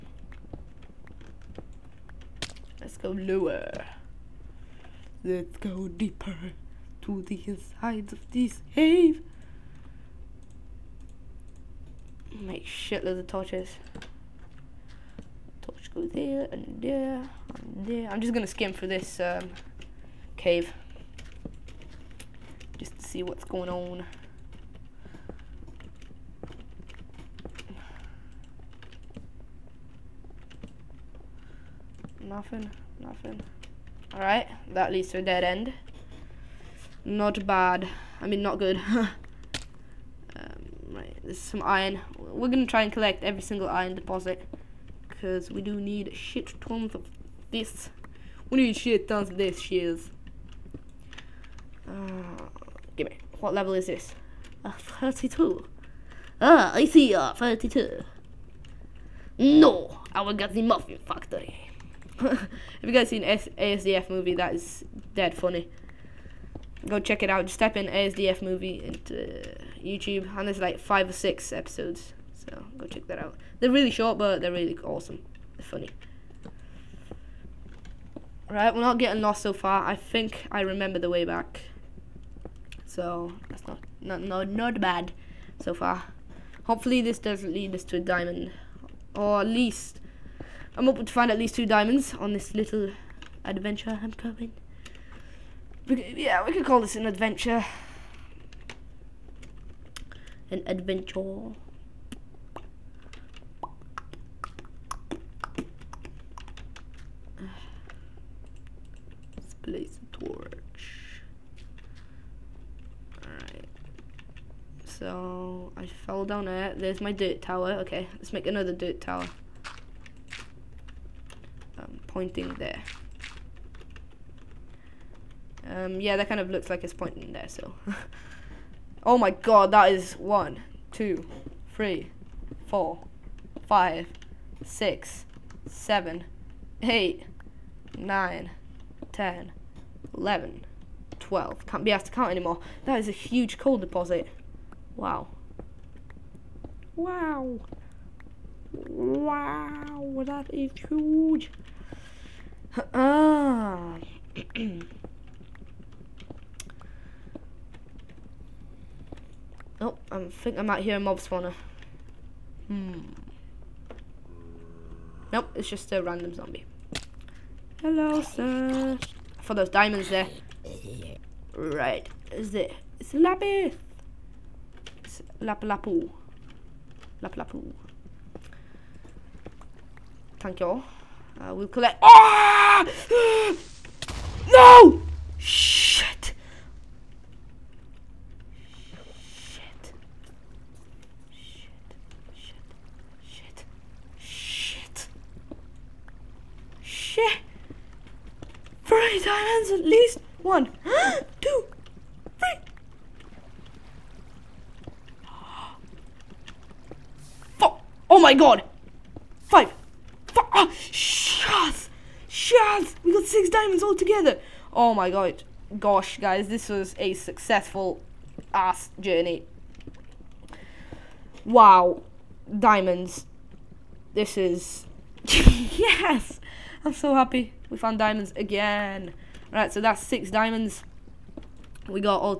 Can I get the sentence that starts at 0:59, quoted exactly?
No, I will get the muffin factory.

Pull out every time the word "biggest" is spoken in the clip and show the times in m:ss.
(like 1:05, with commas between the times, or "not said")
not said.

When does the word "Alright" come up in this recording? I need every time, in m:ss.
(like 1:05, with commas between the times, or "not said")
0:34, 1:53.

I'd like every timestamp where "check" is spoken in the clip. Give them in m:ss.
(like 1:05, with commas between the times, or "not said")
1:06, 1:12.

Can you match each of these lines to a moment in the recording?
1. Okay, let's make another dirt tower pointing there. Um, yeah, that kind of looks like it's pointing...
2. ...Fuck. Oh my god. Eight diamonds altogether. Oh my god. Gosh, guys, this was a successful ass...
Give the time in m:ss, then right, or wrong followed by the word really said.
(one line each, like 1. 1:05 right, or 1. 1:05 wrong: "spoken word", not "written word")
1. 1:57 right
2. 3:27 wrong: "Six", not "Eight".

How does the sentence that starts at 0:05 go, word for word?
Let's go deeper to the insides of this cave.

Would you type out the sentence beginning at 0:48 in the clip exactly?
We need shit tons of this, shears.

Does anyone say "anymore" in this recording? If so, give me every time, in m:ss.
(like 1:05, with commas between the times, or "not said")
2:22.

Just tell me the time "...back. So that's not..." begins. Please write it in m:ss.
1:21.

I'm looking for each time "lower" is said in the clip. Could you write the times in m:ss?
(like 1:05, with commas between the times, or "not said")
0:03.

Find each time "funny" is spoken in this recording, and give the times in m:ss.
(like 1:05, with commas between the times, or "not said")
1:05, 1:15.